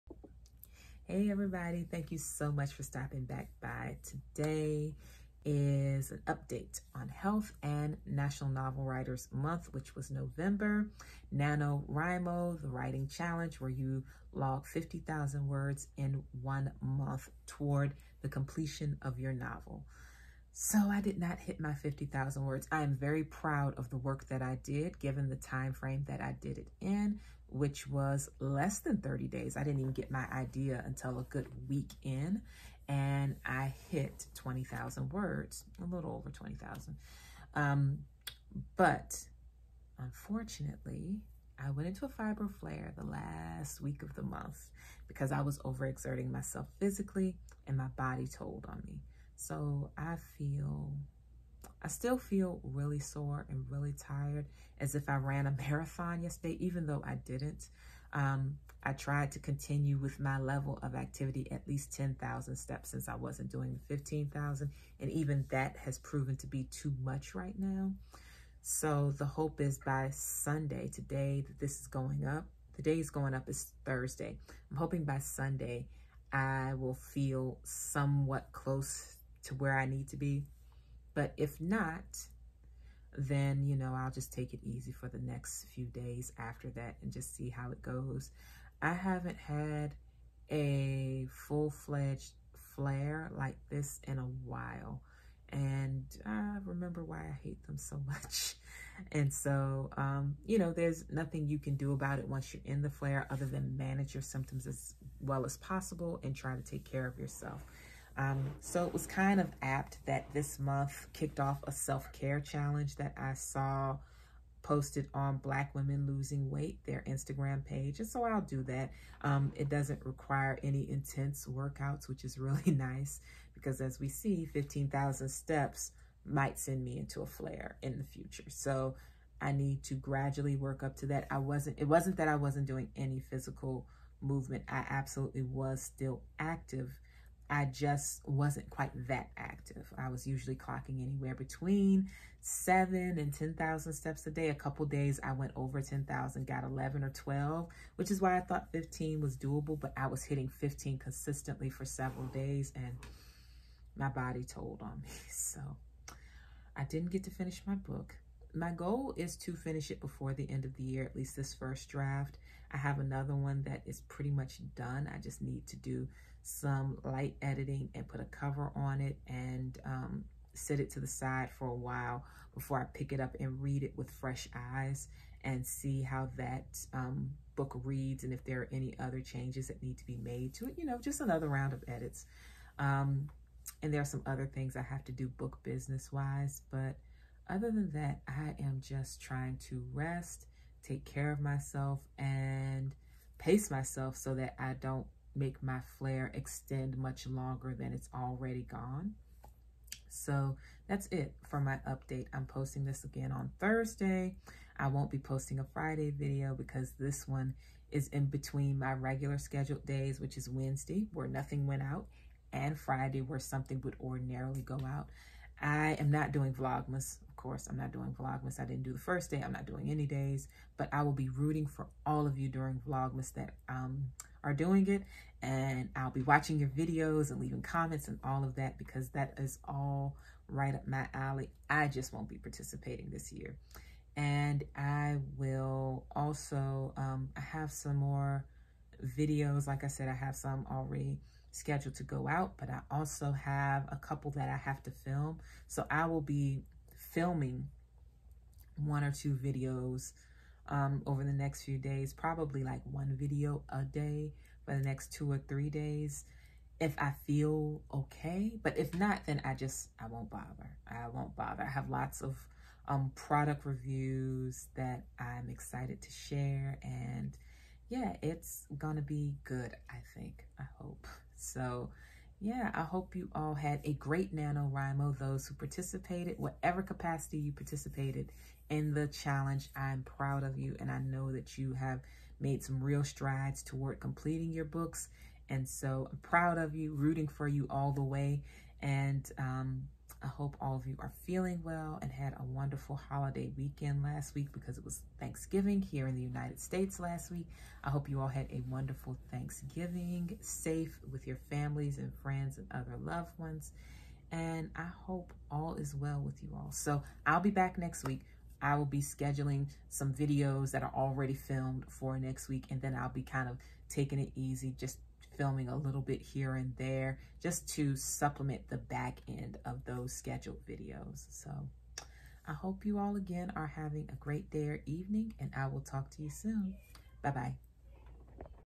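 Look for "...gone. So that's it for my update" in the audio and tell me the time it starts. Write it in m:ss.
3:18.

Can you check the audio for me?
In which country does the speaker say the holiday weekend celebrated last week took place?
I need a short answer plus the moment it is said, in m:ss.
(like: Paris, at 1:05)
United States, at 4:56.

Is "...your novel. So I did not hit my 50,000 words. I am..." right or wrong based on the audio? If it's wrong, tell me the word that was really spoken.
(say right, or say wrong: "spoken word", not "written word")
right.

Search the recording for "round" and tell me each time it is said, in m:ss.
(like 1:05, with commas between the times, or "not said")
3:01.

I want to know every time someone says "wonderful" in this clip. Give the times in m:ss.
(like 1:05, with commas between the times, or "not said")
4:52, 4:58.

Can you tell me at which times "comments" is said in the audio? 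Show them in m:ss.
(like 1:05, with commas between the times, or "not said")
3:47.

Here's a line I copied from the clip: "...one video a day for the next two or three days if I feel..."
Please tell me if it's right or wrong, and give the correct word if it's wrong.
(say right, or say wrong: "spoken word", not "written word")
right.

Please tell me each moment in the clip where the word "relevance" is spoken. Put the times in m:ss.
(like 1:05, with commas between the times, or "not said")
not said.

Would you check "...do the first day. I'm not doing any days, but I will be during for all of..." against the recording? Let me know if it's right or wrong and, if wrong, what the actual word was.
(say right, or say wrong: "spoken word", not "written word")
wrong: "rooting", not "during".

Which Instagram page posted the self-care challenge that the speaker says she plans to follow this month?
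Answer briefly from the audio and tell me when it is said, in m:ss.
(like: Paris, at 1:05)
Black Women Losing Weight, at 1:55.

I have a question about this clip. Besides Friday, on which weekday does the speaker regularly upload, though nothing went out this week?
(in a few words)
Wednesday.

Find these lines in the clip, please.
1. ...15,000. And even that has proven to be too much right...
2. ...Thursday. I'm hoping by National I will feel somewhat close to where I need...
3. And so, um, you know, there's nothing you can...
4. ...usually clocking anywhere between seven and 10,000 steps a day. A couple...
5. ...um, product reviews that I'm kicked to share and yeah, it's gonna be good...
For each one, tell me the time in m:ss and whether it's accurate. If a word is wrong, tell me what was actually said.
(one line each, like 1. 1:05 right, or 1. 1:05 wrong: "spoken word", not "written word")
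1. 1:03 right
2. 1:13 wrong: "Sunday", not "National"
3. 1:39 right
4. 2:20 right
5. 4:22 wrong: "excited", not "kicked".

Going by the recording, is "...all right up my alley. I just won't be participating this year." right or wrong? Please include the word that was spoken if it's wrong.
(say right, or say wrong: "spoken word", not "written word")
right.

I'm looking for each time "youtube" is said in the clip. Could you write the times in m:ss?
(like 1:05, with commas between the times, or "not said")
not said.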